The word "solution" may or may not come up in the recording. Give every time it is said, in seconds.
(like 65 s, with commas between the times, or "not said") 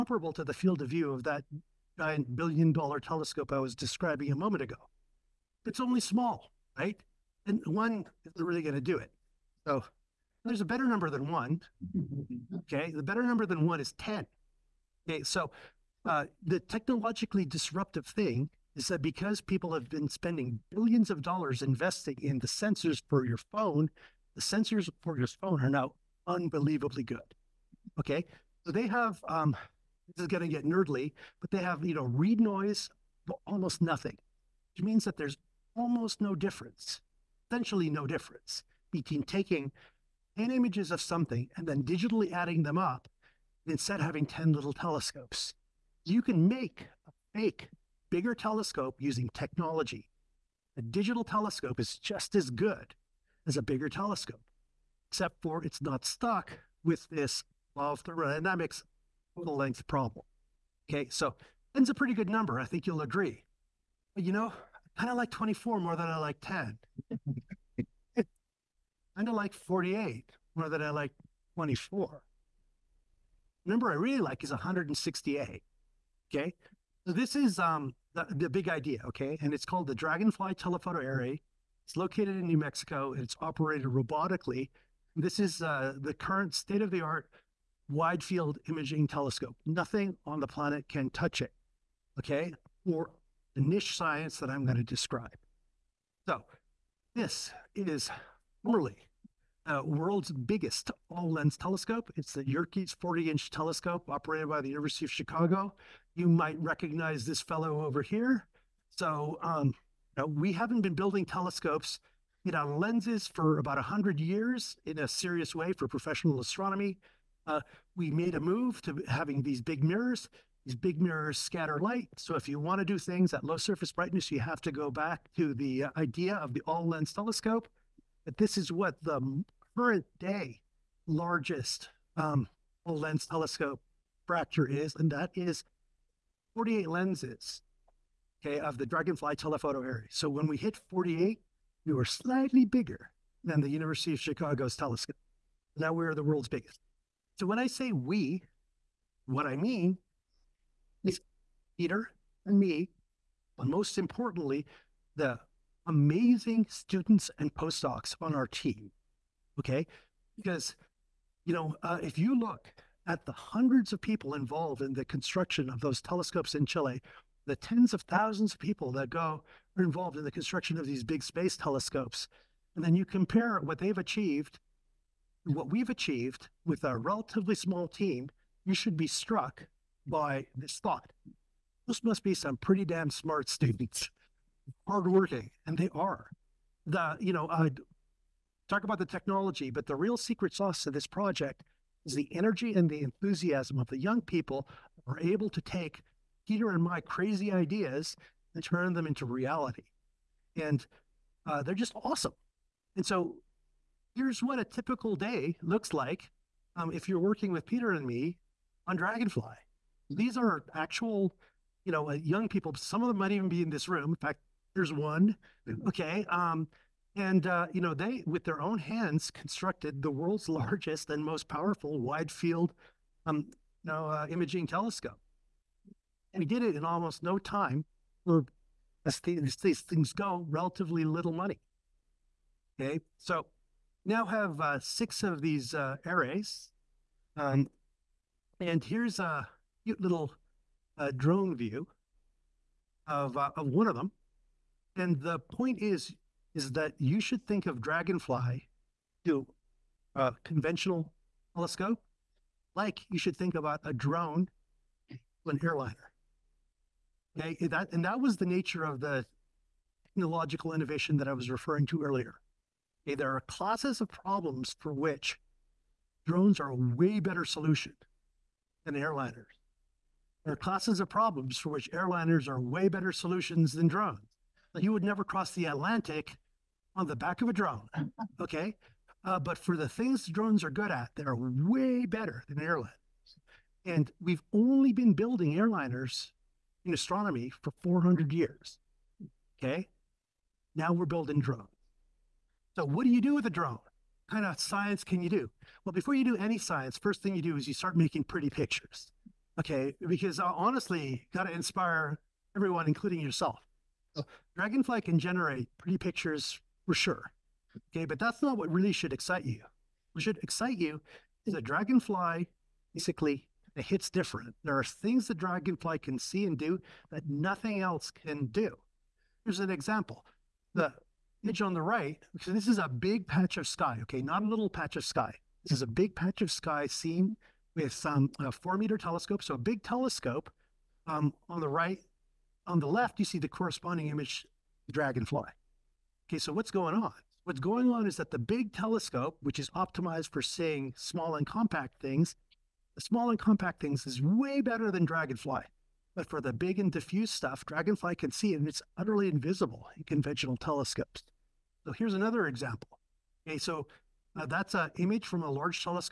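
267 s, 273 s.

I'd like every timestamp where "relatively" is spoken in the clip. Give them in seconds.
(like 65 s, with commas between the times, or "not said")
176 s, 230 s.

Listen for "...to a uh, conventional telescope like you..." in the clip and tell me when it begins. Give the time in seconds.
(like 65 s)
249 s.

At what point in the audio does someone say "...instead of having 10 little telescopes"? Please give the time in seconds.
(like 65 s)
43 s.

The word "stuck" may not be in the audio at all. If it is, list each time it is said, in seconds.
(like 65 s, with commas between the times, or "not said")
56 s.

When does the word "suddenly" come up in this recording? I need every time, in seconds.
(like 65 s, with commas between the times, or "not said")
not said.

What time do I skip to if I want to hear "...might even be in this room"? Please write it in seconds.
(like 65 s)
213 s.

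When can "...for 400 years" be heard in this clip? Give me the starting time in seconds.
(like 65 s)
287 s.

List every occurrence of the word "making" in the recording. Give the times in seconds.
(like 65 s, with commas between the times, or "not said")
297 s.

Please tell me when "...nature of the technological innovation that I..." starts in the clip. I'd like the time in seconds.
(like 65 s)
258 s.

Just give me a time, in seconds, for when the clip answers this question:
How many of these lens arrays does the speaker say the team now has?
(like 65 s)
234 s.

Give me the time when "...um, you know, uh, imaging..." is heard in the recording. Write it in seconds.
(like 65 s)
223 s.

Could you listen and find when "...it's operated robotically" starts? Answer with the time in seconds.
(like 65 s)
83 s.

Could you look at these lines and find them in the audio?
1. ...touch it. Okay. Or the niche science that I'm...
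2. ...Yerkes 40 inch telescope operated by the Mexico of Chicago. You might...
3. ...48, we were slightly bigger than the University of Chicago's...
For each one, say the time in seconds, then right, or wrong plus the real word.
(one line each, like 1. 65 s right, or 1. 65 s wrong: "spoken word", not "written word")
1. 91 s right
2. 102 s wrong: "University", not "Mexico"
3. 140 s right.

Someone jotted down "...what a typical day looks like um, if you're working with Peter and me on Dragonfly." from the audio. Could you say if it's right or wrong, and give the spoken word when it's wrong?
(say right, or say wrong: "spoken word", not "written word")
right.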